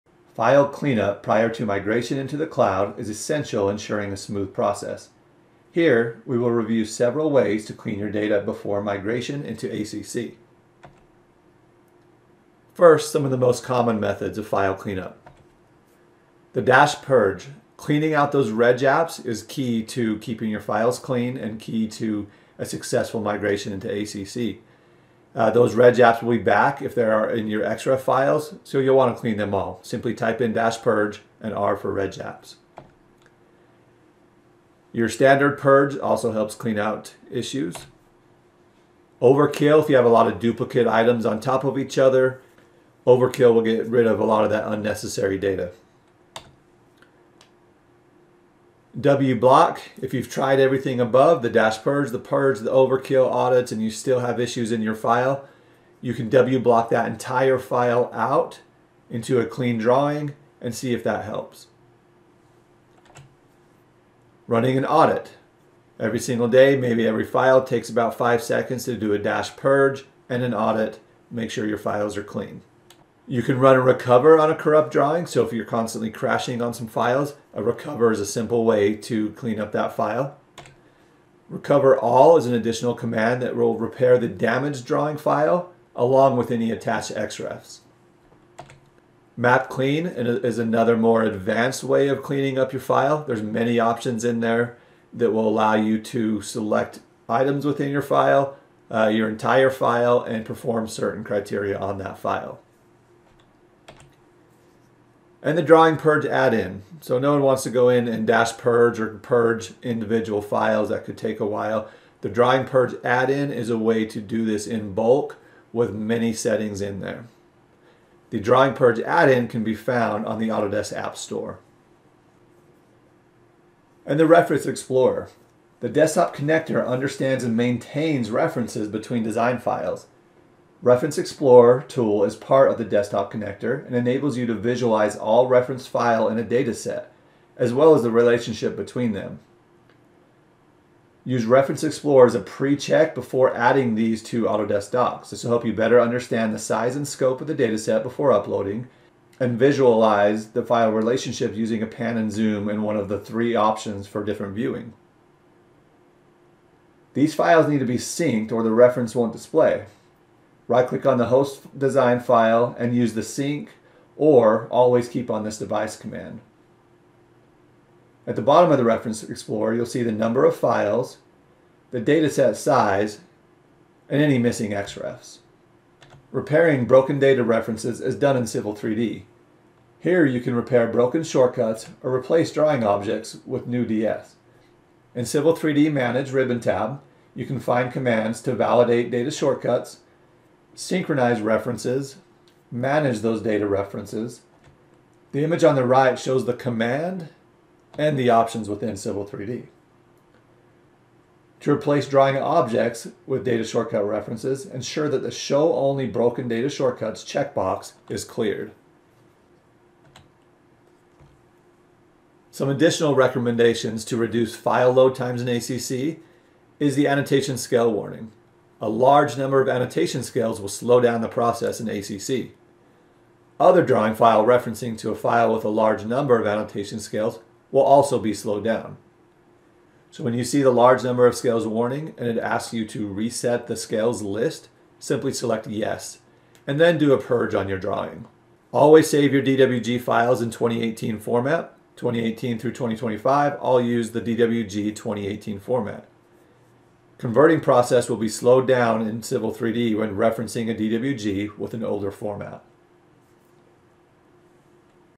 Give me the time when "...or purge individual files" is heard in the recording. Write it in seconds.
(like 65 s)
108 s.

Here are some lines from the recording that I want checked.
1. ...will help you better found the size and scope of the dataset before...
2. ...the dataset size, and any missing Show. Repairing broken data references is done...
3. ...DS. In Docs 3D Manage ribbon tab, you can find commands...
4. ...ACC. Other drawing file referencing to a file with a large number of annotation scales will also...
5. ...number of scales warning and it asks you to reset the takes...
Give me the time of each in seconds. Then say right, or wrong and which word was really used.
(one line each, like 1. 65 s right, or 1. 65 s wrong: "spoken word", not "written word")
1. 145 s wrong: "understand", not "found"
2. 171 s wrong: "XREFs", not "Show"
3. 183 s wrong: "Civil", not "Docs"
4. 221 s right
5. 231 s wrong: "scales", not "takes".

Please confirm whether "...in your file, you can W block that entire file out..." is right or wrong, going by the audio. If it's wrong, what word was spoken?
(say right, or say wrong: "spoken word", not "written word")
right.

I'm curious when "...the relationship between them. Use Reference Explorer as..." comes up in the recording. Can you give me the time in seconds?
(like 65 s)
138 s.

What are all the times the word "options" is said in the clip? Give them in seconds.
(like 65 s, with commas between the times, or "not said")
93 s, 153 s, 198 s.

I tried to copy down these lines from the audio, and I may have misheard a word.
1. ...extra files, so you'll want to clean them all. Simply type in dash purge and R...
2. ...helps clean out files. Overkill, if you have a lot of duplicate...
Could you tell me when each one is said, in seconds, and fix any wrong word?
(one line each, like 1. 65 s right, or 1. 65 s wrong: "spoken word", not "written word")
1. 27 s right
2. 36 s wrong: "issues", not "files".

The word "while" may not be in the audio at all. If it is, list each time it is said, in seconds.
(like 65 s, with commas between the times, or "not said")
111 s.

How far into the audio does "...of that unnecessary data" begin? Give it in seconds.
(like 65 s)
44 s.